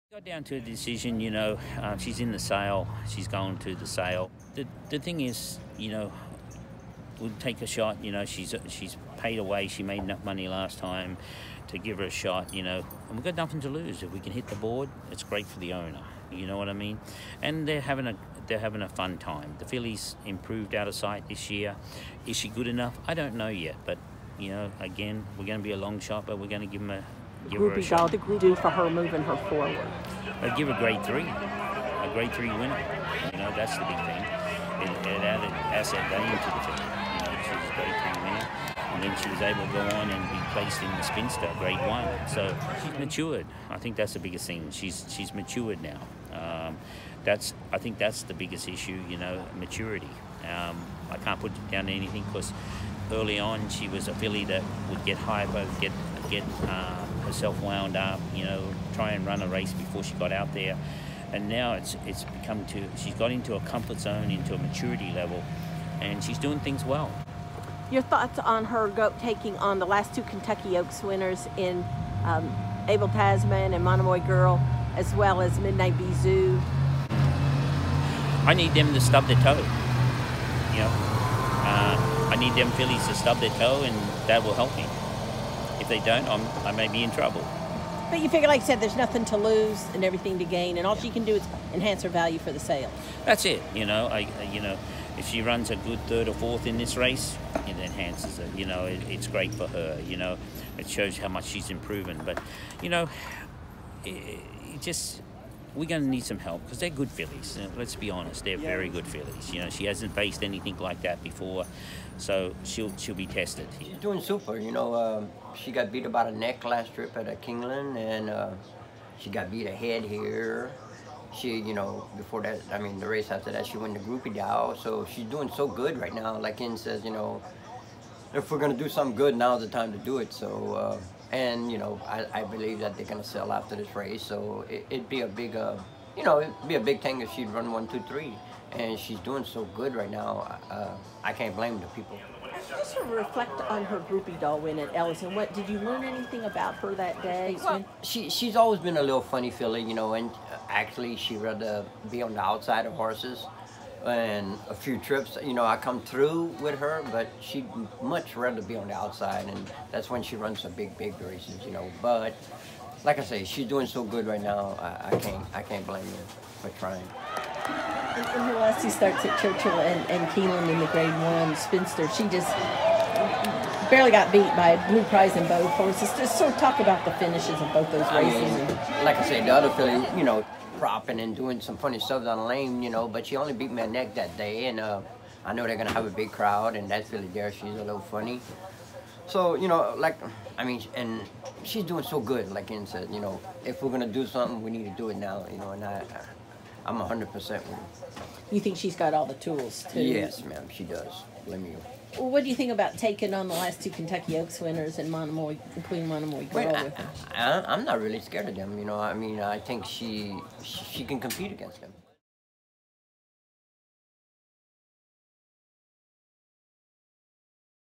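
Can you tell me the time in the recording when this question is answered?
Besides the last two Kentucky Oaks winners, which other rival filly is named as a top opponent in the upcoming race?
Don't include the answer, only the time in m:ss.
1:15.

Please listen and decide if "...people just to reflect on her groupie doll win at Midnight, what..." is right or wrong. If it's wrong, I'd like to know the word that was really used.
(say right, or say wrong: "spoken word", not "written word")
wrong: "Ellison", not "Midnight".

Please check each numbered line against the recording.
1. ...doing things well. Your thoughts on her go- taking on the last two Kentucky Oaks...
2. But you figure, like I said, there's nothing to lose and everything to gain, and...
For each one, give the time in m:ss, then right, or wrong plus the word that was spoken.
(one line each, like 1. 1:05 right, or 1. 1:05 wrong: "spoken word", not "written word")
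1. 1:06 right
2. 1:28 right.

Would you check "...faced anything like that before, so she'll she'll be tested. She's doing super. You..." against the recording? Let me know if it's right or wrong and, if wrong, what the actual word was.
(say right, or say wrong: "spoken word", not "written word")
right.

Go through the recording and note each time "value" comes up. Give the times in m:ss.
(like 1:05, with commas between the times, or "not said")
0:36, 1:32.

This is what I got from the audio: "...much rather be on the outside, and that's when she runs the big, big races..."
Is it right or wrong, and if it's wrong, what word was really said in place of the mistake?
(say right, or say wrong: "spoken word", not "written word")
right.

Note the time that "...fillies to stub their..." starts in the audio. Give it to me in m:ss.
1:22.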